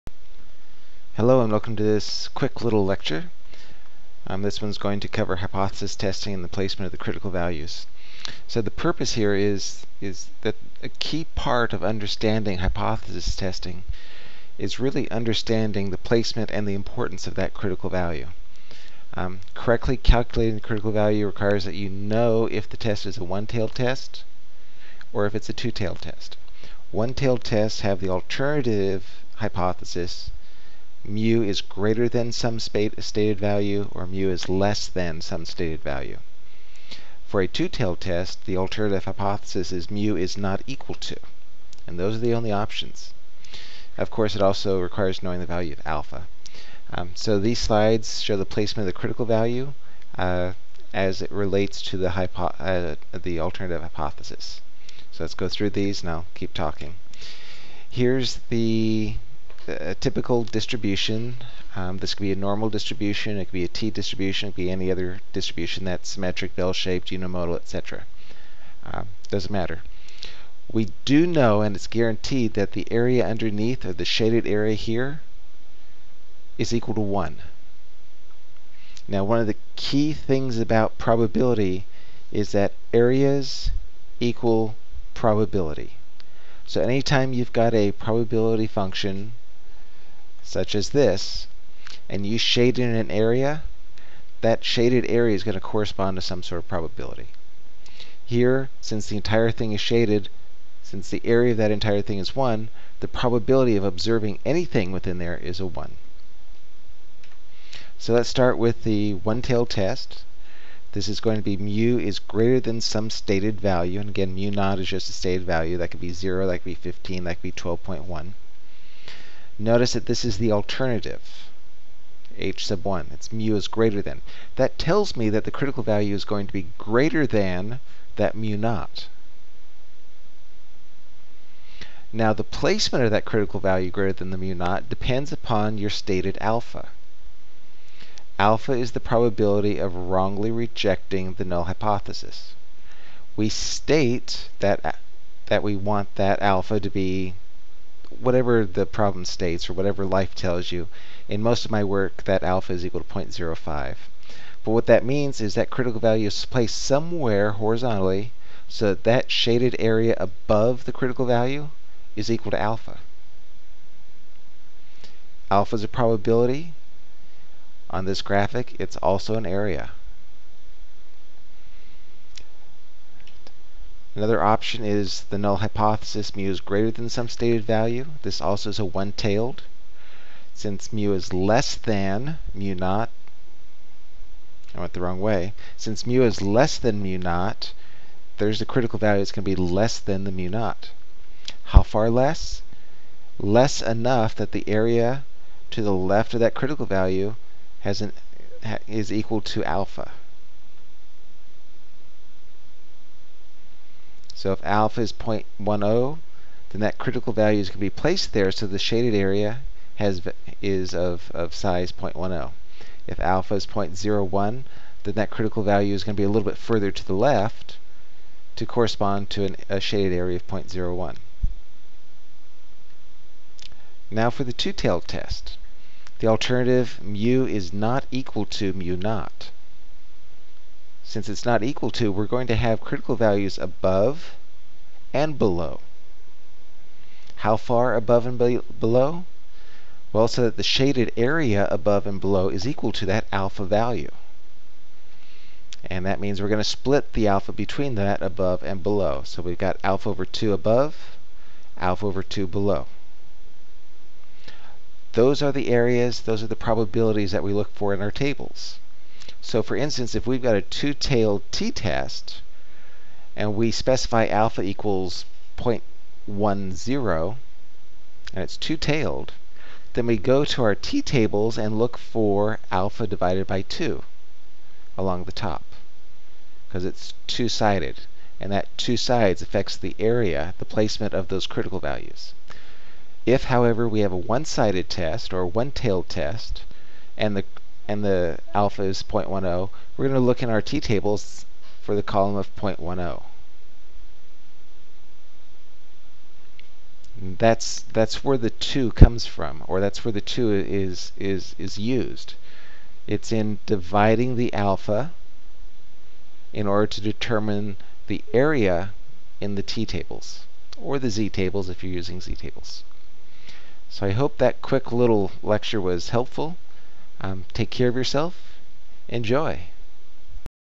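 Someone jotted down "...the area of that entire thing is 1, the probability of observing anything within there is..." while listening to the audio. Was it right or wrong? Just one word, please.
right.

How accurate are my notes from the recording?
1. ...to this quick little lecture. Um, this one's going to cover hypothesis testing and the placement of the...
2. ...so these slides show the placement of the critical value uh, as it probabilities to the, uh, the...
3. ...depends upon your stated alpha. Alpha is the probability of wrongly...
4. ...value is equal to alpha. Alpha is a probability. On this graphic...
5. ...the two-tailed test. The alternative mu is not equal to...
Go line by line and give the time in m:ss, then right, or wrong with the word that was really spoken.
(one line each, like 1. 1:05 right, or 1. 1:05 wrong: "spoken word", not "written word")
1. 0:01 right
2. 0:47 wrong: "relates", not "probabilities"
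3. 2:14 right
4. 2:41 right
5. 3:44 right.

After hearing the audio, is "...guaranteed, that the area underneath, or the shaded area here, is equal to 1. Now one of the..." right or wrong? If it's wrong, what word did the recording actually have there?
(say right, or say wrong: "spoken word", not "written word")
right.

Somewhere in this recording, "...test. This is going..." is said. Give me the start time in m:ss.
1:49.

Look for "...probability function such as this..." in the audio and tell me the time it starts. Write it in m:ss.
1:27.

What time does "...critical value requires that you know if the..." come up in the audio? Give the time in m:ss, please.
0:20.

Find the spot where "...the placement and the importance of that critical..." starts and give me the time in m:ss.
0:15.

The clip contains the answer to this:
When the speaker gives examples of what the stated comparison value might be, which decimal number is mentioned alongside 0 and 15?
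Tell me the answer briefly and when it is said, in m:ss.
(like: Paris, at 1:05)
12.1, at 1:57.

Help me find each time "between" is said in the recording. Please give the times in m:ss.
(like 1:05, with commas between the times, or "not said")
4:07.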